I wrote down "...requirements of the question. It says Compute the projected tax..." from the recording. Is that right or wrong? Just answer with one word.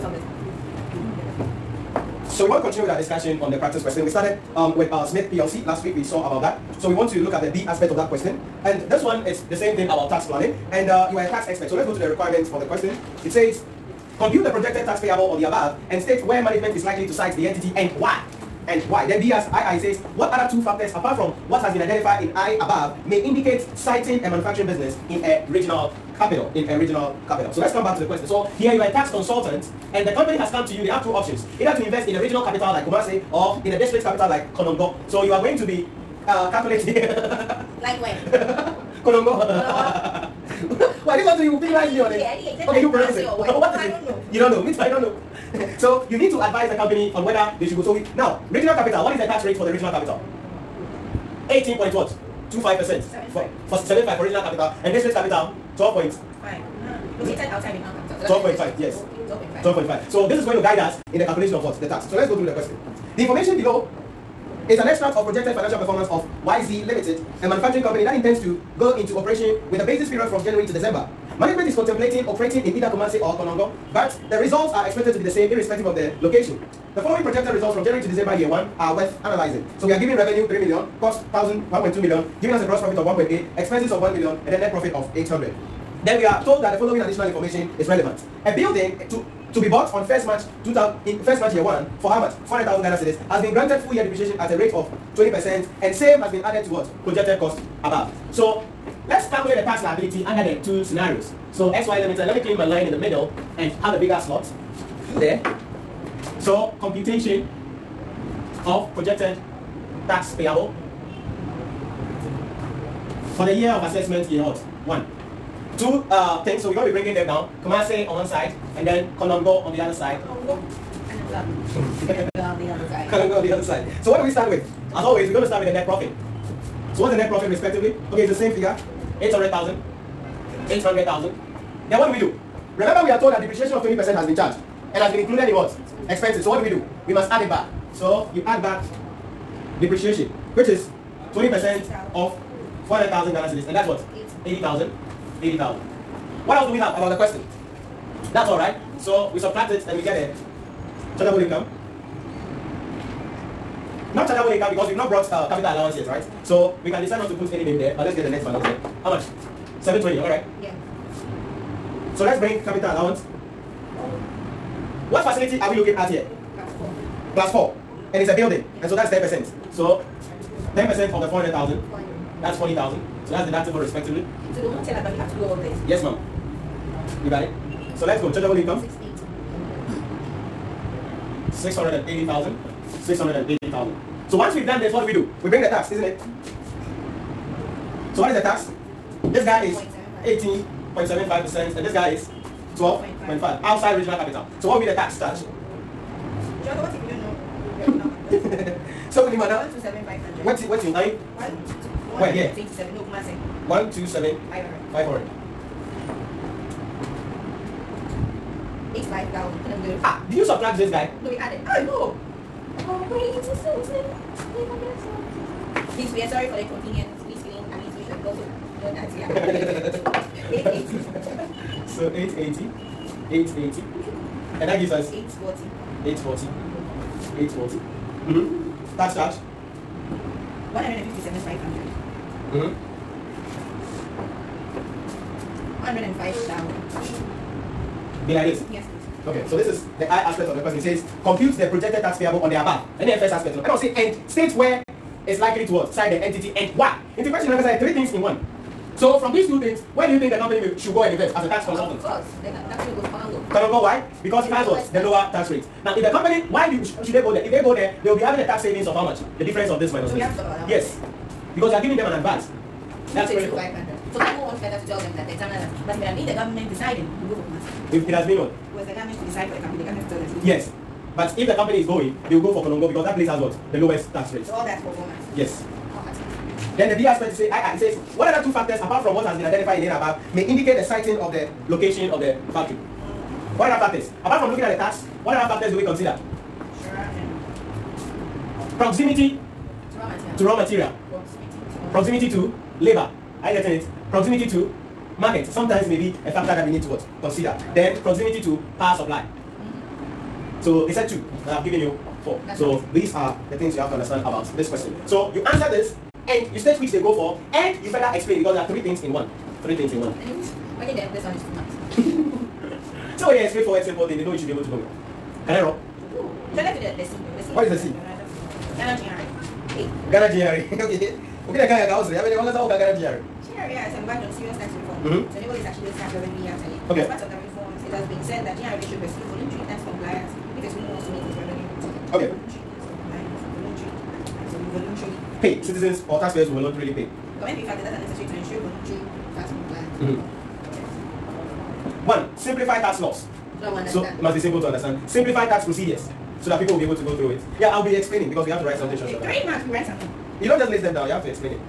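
right.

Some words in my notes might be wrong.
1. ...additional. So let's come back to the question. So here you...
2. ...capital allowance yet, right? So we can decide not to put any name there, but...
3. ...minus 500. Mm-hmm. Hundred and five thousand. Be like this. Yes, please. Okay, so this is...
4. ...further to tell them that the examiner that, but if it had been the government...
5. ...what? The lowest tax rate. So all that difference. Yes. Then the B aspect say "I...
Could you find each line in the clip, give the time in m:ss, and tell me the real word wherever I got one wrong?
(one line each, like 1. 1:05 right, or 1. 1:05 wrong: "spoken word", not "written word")
1. 0:27 wrong: "capital", not "additional"
2. 2:35 right
3. 3:51 right
4. 4:24 right
5. 4:33 wrong: "performance", not "difference".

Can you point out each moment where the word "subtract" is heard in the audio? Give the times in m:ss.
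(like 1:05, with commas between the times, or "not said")
2:29, 3:30.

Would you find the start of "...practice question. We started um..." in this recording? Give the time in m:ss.
0:03.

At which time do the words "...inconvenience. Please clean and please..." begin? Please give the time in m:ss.
3:36.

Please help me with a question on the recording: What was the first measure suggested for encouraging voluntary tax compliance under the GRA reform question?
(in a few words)
simplify tax laws.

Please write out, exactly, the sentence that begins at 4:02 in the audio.
And the first aspect, you know.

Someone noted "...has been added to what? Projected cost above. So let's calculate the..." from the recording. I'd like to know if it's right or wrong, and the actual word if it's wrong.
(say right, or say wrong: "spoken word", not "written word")
right.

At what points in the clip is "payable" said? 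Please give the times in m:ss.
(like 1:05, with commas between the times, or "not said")
0:14, 1:50, 4:02.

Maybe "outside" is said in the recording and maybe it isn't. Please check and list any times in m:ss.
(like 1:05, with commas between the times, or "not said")
0:57, 3:13.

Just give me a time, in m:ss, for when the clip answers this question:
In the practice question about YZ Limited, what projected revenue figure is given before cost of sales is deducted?
1:20.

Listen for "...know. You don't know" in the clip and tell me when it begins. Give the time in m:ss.
0:44.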